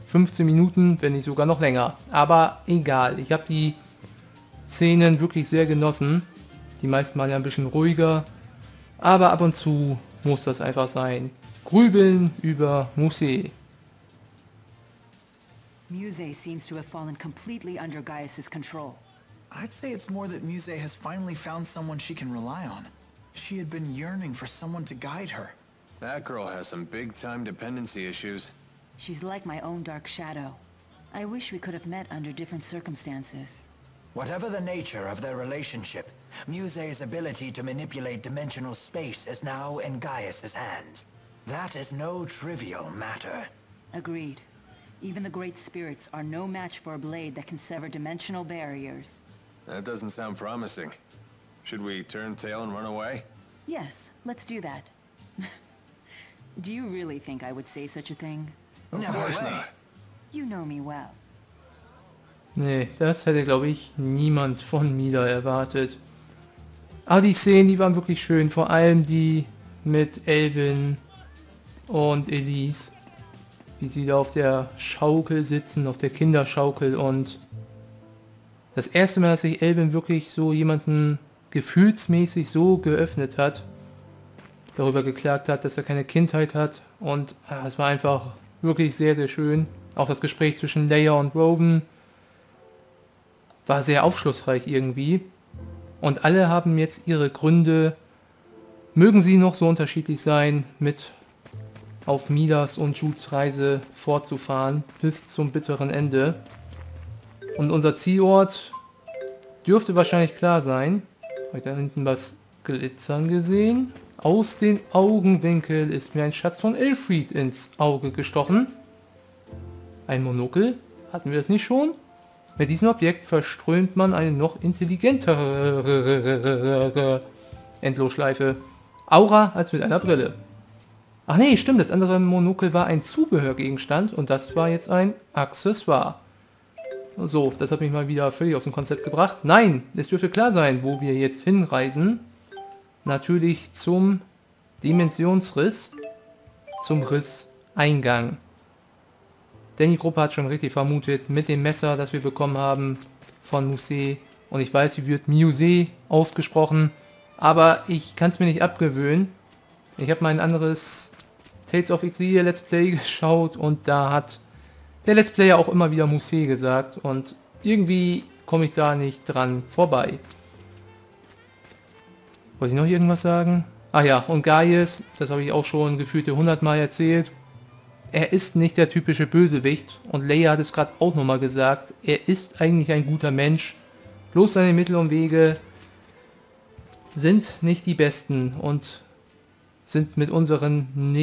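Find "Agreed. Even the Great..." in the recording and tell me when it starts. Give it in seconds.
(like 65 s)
43 s.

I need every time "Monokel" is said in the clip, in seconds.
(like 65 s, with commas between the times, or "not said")
120 s, 132 s.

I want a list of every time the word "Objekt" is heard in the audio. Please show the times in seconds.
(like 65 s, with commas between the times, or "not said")
122 s.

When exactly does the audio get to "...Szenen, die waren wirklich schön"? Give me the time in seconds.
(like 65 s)
67 s.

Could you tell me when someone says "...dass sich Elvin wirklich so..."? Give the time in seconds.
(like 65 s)
79 s.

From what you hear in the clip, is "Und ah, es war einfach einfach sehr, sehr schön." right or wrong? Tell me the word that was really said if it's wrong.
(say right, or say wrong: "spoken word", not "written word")
wrong: "wirklich", not "einfach".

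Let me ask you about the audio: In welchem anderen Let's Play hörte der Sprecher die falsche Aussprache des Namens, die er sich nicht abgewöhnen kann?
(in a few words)
Tales of Exile.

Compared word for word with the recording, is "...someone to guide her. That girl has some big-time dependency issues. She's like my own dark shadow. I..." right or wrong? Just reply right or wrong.
right.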